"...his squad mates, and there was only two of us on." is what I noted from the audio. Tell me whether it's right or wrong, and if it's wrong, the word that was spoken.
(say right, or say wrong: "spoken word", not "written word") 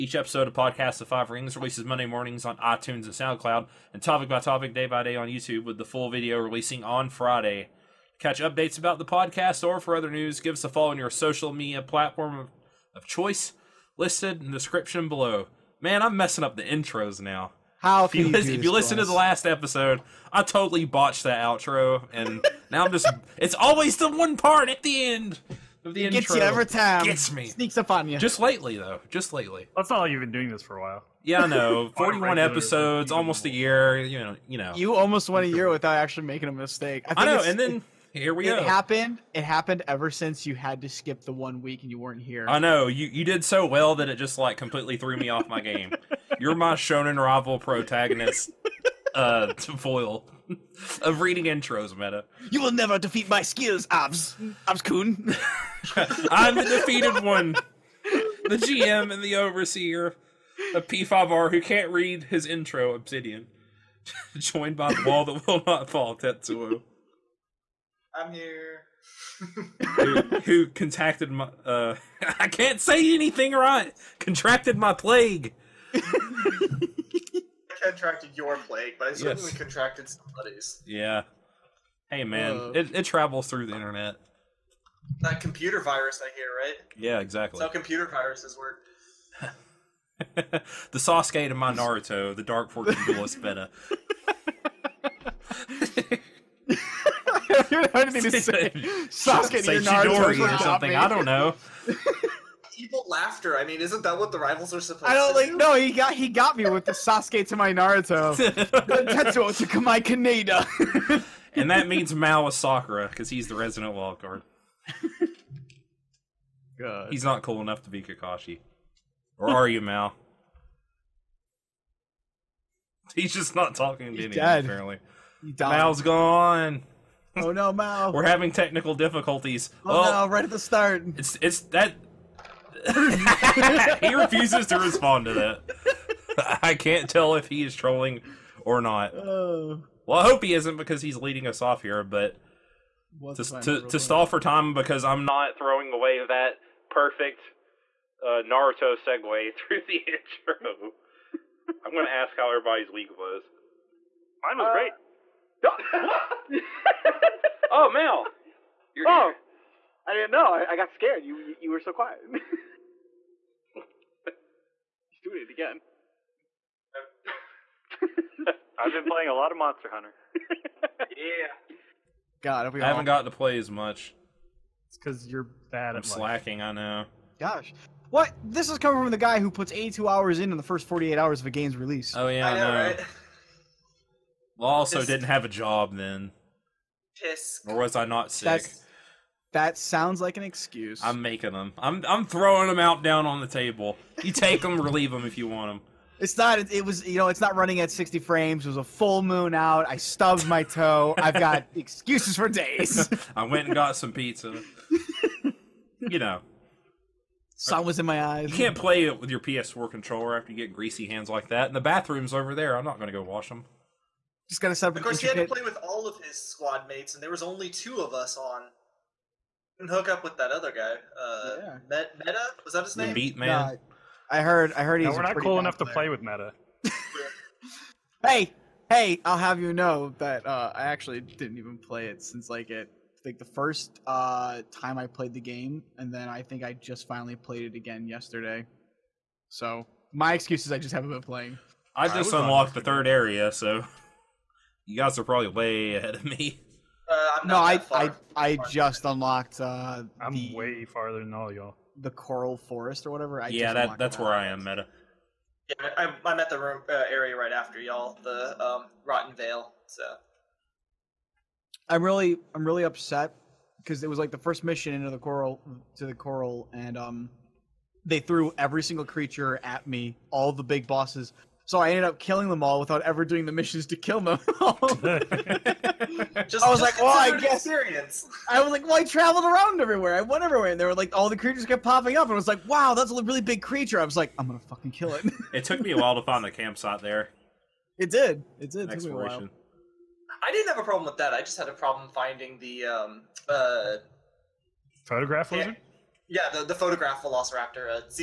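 right.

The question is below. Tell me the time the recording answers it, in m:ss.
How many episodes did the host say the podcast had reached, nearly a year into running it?
0:31.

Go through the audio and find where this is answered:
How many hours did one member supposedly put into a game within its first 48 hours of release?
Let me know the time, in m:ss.
2:59.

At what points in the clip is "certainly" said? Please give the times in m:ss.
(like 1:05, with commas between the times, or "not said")
1:19.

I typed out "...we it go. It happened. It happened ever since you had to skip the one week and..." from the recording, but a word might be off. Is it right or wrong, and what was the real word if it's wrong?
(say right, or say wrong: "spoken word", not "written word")
right.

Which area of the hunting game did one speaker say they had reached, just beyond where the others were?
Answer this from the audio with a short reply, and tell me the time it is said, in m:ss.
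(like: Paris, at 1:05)
Rotten Vale, at 4:19.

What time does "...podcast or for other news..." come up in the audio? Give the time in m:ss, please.
0:09.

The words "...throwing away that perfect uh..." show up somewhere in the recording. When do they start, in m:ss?
2:25.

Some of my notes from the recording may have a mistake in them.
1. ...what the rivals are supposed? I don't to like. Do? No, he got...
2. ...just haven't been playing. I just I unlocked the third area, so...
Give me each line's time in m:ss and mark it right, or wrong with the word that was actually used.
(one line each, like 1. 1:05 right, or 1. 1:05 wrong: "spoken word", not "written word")
1. 1:44 right
2. 4:00 right.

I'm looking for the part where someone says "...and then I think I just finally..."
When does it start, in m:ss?
3:55.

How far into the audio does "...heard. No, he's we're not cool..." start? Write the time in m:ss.
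3:44.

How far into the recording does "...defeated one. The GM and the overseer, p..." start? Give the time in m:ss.
0:56.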